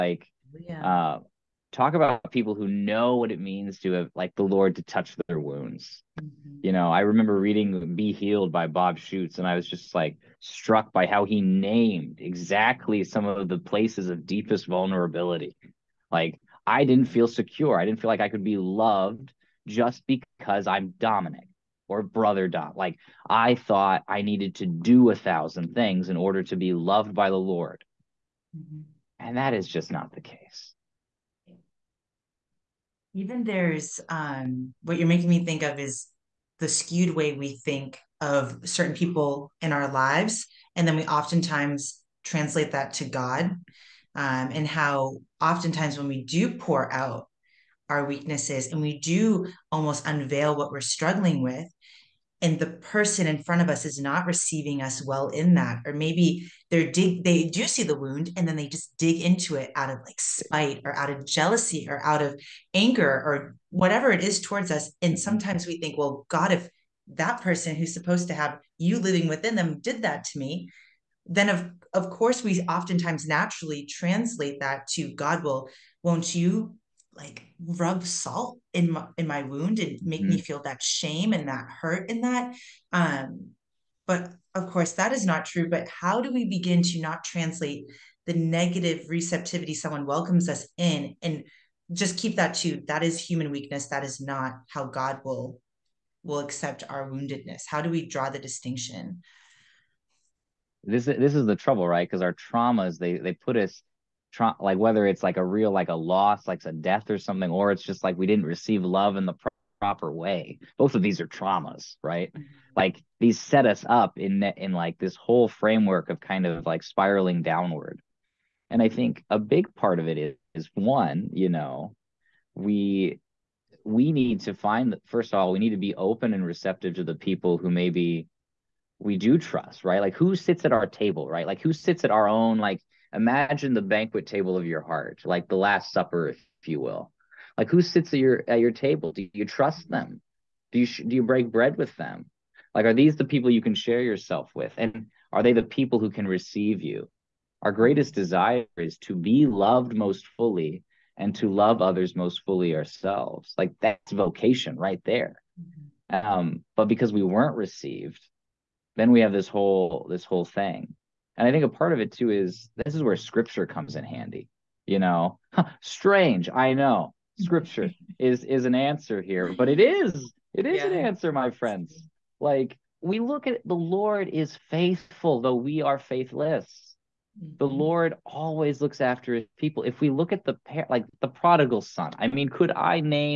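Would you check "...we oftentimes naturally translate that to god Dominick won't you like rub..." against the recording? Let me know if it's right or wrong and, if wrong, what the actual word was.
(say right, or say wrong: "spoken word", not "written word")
wrong: "Will", not "Dominick".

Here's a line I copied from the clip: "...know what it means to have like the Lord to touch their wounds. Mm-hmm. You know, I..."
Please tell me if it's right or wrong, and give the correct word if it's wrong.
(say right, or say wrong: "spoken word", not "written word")
right.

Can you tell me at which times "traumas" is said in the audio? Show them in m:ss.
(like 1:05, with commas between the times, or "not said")
1:42, 1:51.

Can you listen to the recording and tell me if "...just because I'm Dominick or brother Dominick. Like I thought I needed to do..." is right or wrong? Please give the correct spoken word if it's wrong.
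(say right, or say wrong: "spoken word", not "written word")
wrong: "Dot", not "Dominick".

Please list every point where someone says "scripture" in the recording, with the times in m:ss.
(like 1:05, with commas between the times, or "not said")
2:43, 2:47.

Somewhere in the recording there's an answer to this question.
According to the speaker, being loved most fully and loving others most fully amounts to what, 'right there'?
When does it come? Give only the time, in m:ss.
2:34.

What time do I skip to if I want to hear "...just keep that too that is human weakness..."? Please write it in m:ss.
1:31.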